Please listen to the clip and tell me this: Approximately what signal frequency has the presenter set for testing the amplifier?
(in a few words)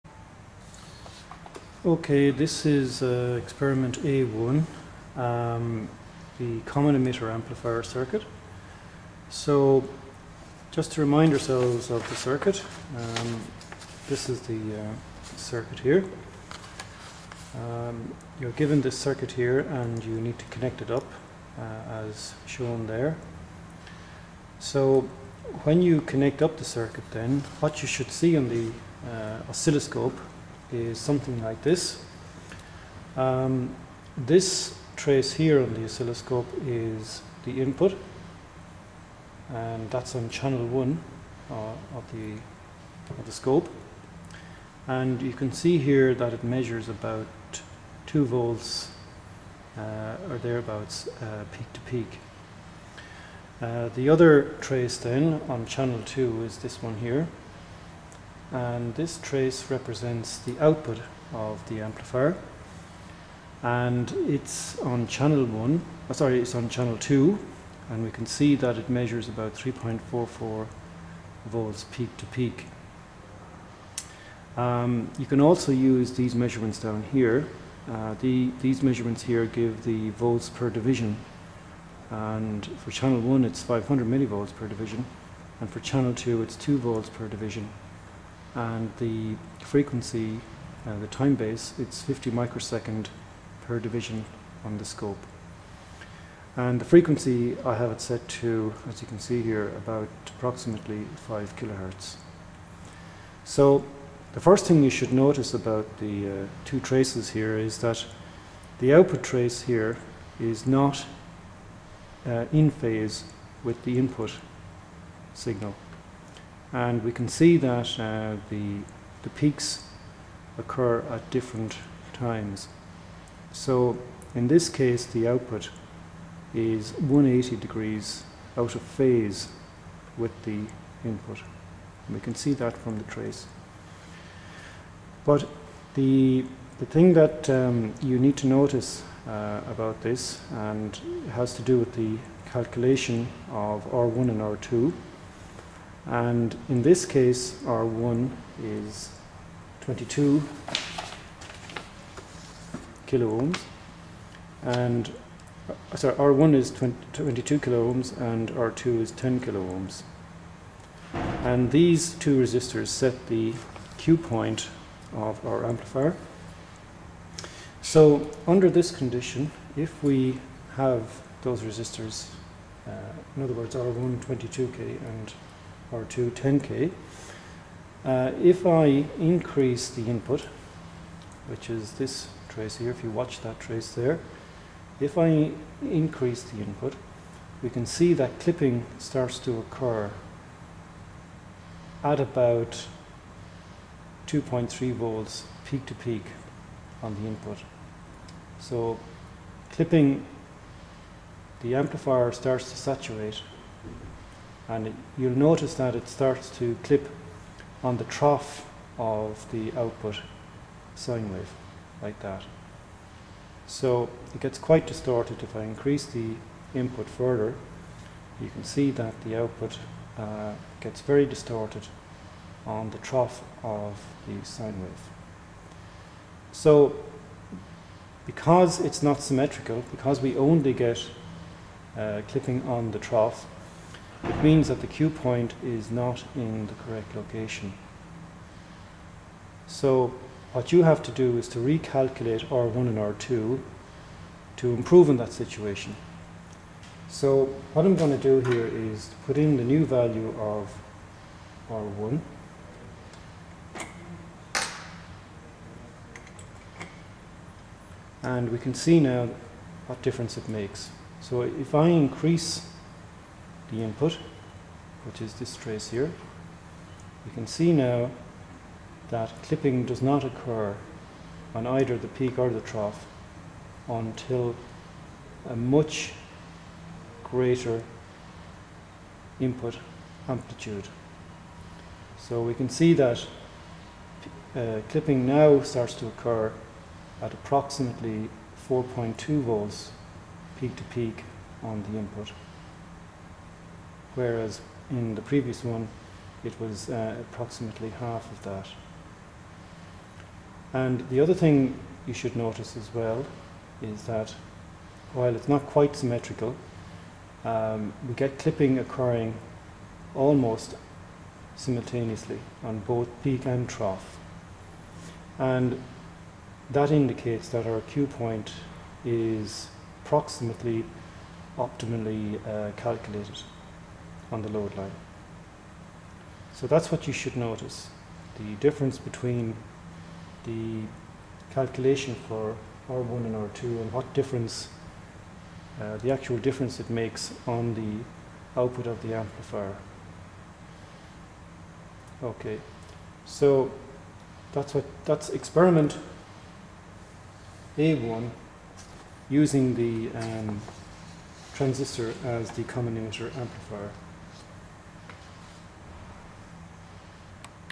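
5 kilohertz.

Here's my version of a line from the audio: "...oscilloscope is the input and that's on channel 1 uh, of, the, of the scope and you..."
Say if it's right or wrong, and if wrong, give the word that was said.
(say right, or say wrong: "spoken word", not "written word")
right.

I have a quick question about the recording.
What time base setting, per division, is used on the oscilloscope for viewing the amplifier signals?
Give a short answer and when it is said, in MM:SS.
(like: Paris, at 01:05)
50 microseconds, at 01:32.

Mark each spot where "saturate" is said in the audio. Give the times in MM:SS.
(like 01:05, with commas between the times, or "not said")
03:22.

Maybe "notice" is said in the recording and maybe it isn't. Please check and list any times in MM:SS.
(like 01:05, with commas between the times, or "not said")
01:45, 02:18, 03:25, 05:02, 05:27.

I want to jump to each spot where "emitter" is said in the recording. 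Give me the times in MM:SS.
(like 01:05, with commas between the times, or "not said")
00:06, 05:52.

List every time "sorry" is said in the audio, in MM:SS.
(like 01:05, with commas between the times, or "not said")
01:06, 02:35.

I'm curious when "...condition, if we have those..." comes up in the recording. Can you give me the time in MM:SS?
02:48.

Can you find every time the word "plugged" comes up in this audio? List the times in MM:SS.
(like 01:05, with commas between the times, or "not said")
not said.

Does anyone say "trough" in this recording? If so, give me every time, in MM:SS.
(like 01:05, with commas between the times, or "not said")
03:28, 03:42, 03:52, 04:32, 05:13.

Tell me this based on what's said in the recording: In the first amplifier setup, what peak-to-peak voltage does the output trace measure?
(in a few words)
3.44 volts.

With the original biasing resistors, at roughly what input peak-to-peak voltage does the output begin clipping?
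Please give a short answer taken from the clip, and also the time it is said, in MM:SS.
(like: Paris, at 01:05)
2.3 volts, at 03:14.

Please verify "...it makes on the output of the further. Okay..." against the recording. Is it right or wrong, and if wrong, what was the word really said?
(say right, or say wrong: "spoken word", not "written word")
wrong: "amplifier", not "further".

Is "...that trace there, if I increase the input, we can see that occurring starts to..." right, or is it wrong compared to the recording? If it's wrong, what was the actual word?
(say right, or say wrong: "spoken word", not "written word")
wrong: "clipping", not "occurring".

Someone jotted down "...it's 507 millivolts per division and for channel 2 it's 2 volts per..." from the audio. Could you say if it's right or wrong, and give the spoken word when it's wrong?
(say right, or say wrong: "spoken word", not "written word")
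wrong: "500", not "507".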